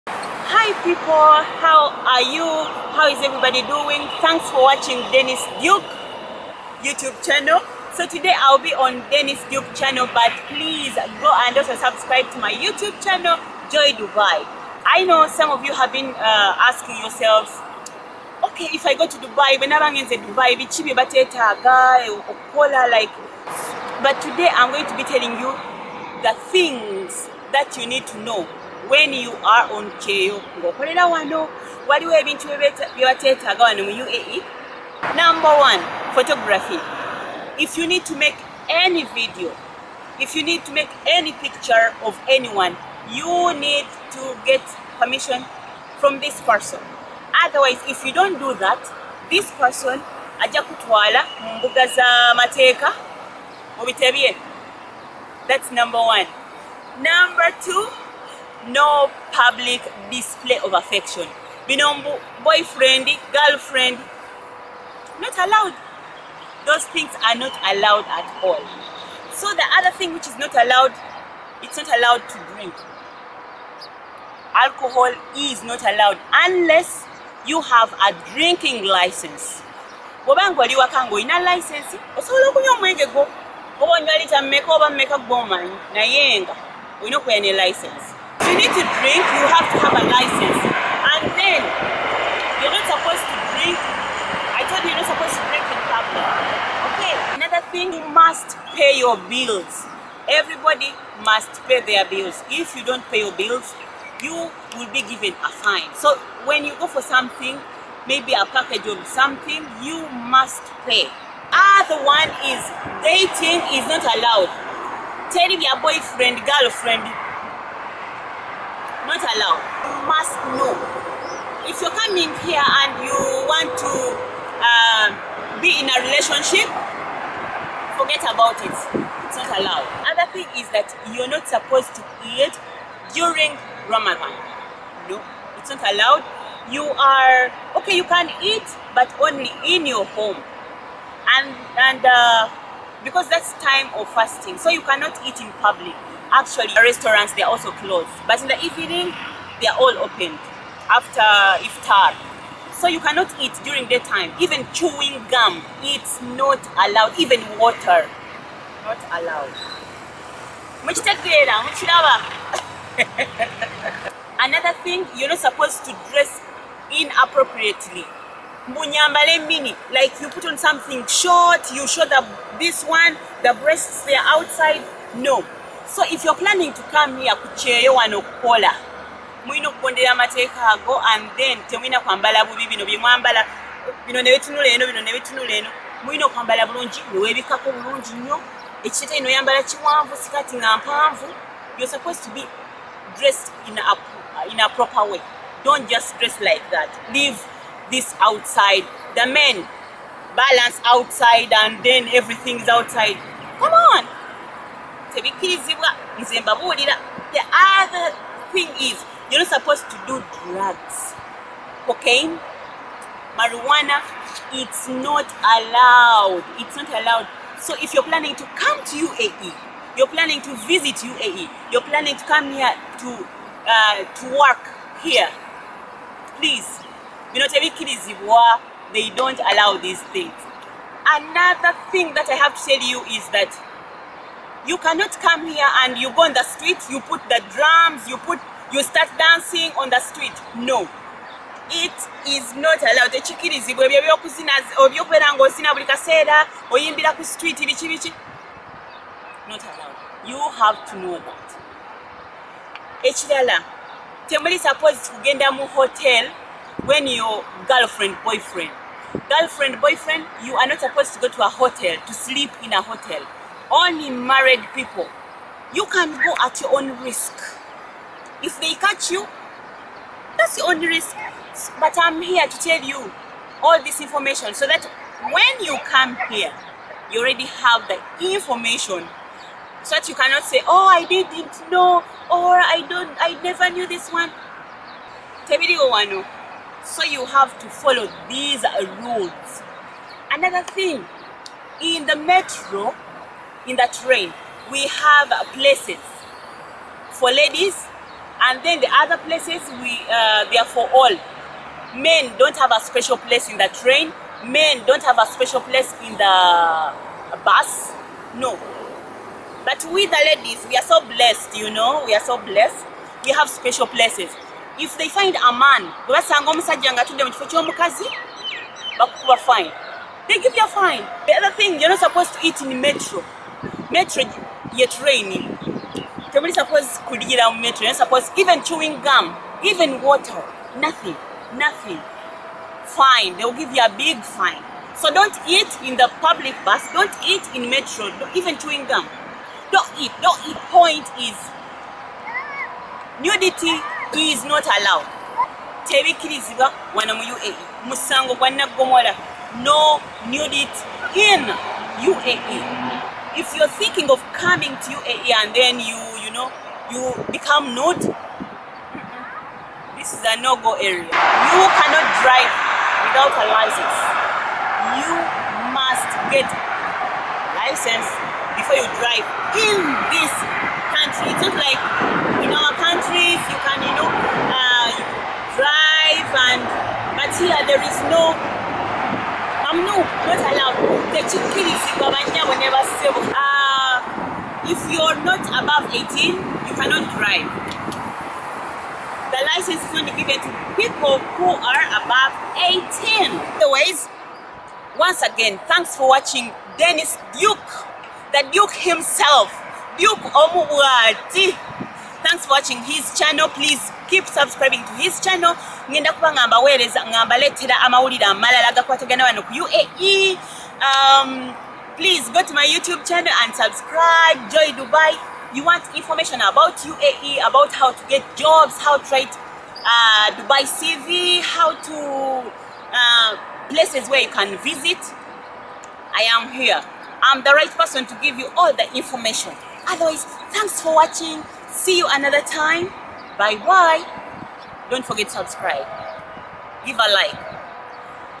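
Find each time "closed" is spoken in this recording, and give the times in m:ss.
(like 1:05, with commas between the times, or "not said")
2:27.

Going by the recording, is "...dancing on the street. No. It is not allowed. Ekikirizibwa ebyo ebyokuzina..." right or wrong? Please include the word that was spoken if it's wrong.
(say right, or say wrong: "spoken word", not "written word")
right.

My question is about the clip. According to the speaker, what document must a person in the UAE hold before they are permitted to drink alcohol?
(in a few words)
Drinking license.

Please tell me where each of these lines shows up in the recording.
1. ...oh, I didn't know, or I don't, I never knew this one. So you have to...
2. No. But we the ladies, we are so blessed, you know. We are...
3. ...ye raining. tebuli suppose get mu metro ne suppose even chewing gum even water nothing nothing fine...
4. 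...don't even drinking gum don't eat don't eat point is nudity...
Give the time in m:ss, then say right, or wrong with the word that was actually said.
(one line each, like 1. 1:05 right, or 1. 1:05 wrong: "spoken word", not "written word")
1. 4:40 right
2. 5:08 right
3. 5:24 right
4. 5:38 wrong: "chewing", not "drinking".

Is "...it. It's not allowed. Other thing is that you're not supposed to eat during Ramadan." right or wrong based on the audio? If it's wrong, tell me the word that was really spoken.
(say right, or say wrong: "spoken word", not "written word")
right.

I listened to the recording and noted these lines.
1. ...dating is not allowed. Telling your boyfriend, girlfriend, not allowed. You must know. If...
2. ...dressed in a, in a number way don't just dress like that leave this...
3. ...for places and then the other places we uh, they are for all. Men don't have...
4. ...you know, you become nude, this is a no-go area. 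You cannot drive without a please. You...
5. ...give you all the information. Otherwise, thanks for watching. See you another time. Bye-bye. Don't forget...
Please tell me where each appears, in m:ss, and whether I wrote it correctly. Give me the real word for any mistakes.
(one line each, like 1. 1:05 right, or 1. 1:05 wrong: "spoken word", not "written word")
1. 1:53 right
2. 3:13 wrong: "proper", not "number"
3. 4:57 wrong: "ladies", not "places"
4. 5:56 wrong: "license", not "please"
5. 7:08 right.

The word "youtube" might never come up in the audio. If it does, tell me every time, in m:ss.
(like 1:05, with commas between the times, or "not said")
0:06, 0:12, 6:52.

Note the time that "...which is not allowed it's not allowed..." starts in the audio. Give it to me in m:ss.
1:10.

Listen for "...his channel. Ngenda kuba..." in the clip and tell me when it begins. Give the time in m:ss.
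6:45.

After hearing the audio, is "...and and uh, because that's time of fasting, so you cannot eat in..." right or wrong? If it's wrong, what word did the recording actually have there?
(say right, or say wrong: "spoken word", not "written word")
right.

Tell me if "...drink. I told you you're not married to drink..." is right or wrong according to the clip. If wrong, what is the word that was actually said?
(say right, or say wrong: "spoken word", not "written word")
wrong: "supposed", not "married".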